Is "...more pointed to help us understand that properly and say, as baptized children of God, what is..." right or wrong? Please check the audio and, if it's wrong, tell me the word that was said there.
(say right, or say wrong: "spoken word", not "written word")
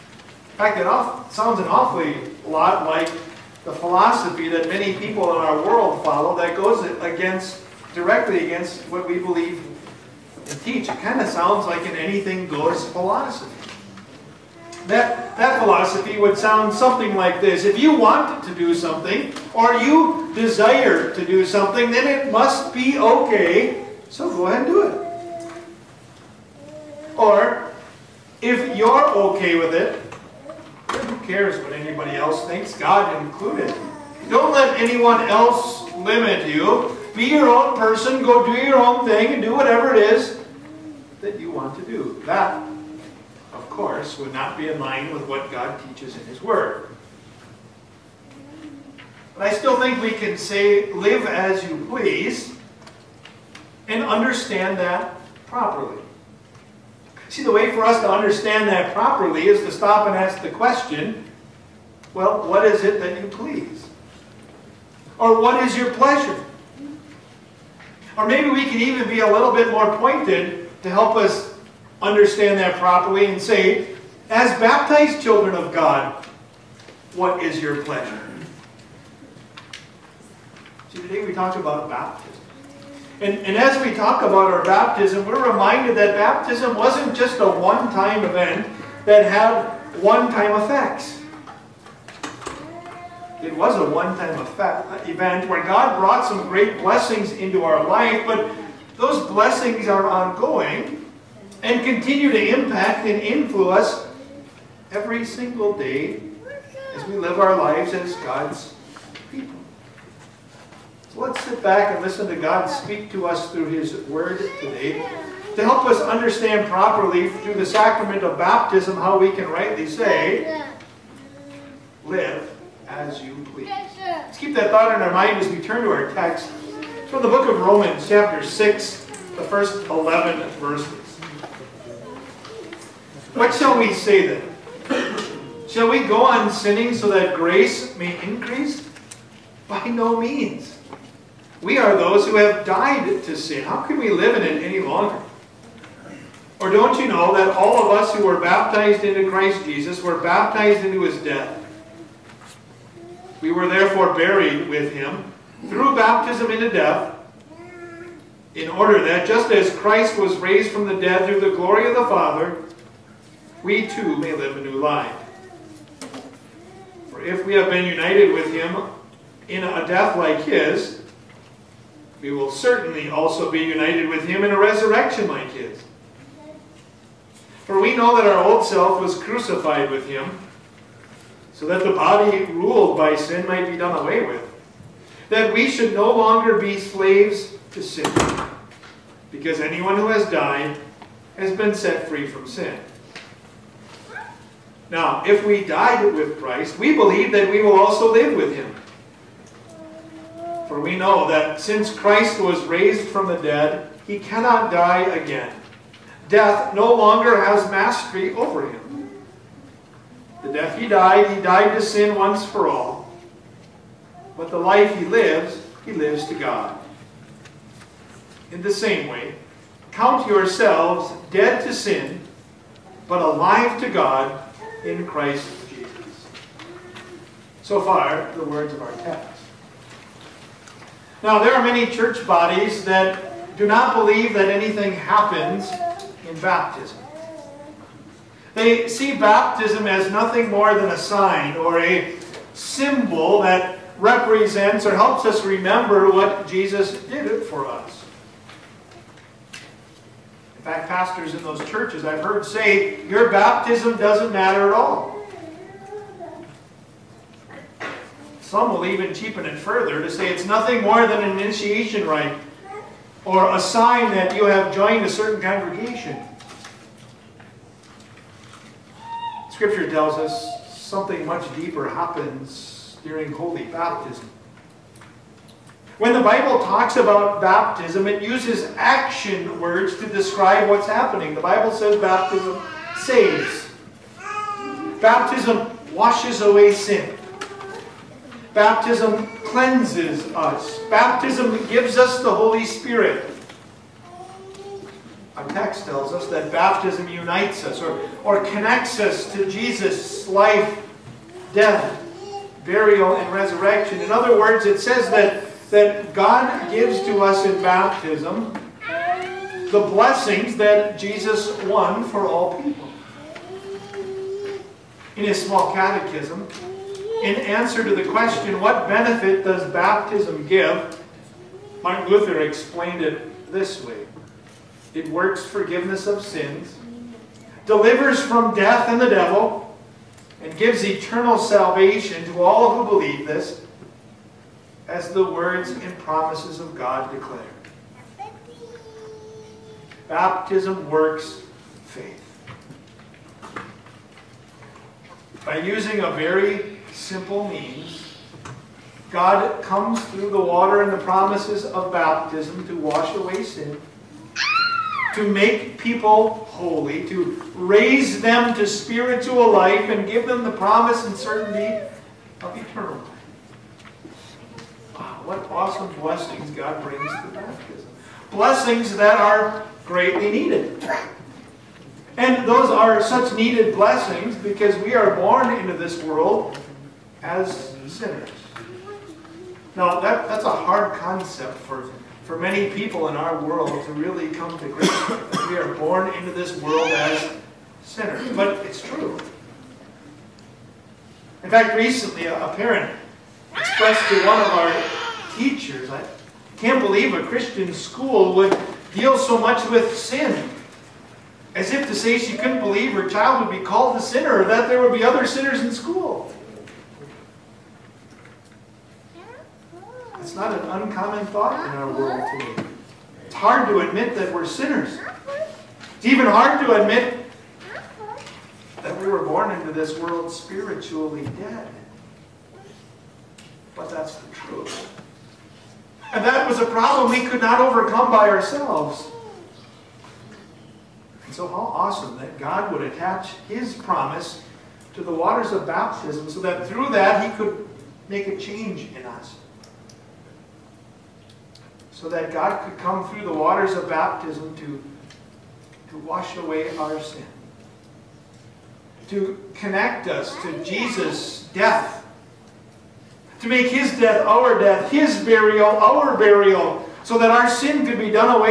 right.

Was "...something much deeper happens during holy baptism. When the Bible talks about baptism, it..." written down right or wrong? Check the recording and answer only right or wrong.
right.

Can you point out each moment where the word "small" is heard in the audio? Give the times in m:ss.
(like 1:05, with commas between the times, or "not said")
5:15.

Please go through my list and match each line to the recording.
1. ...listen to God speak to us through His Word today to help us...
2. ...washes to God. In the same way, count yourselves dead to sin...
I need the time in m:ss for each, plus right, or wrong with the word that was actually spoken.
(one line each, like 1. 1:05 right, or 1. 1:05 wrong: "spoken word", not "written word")
1. 1:52 right
2. 3:35 wrong: "lives", not "washes".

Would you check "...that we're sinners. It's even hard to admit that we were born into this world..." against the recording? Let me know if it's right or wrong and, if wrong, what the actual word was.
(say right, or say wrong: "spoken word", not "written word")
right.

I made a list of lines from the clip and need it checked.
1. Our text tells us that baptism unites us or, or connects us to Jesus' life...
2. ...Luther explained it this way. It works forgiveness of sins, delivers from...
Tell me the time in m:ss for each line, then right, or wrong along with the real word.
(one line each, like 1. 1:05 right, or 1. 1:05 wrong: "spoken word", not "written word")
1. 4:55 right
2. 5:22 right.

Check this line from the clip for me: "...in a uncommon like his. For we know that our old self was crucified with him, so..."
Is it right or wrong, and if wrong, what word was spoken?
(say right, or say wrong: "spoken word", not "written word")
wrong: "resurrection", not "uncommon".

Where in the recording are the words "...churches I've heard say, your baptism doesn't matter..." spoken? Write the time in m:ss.
4:11.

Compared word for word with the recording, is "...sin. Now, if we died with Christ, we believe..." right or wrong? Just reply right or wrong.
right.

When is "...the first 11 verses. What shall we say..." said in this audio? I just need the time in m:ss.
2:09.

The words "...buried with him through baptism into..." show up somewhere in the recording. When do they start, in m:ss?
2:34.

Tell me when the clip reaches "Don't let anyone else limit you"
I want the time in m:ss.
0:34.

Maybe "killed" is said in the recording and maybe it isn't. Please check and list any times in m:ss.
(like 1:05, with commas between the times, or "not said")
not said.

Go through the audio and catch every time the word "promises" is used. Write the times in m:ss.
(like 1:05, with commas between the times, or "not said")
5:35, 5:51, 6:00, 7:13.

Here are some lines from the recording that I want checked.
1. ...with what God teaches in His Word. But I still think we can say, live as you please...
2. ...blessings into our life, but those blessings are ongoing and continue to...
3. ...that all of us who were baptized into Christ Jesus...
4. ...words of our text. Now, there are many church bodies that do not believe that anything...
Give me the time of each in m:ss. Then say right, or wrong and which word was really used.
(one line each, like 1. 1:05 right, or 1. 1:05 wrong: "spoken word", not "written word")
1. 0:45 right
2. 1:36 right
3. 2:27 right
4. 3:48 right.